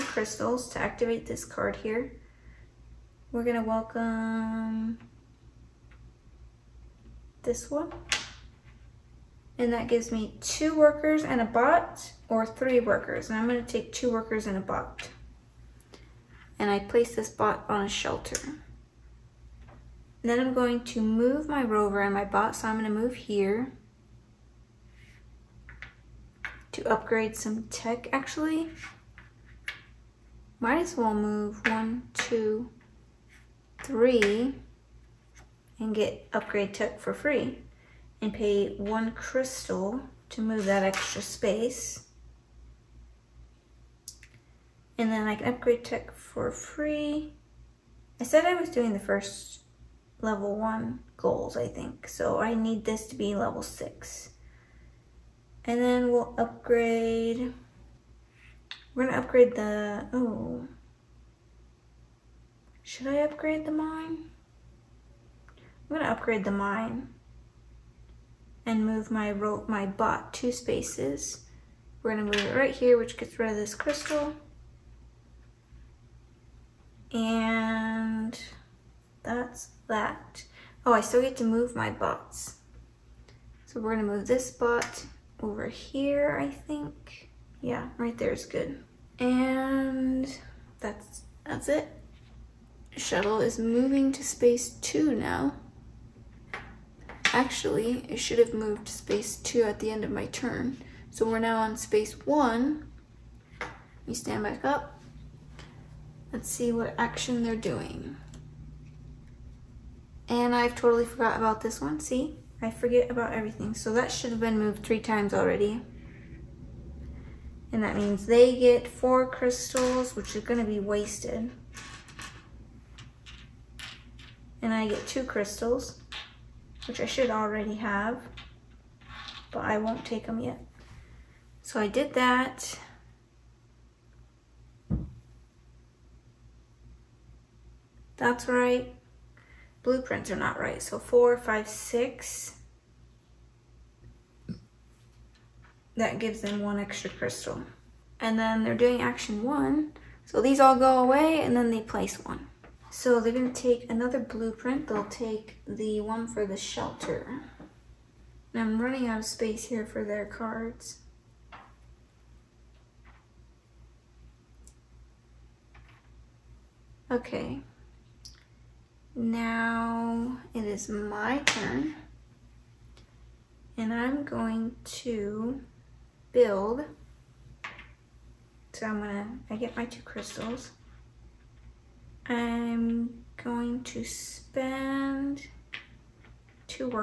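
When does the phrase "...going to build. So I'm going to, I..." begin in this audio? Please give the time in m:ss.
2:54.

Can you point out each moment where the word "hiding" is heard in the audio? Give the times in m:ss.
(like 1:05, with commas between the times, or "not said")
not said.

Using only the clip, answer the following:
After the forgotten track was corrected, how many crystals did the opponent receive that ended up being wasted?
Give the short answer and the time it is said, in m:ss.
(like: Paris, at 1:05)
4, at 1:58.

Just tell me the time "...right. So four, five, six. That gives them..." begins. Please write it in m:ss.
2:20.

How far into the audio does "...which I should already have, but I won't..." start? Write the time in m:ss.
2:06.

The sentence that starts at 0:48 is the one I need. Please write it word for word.
I said I was doing the first level one goals, I think.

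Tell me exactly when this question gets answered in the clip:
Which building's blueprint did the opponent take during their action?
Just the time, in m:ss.
2:36.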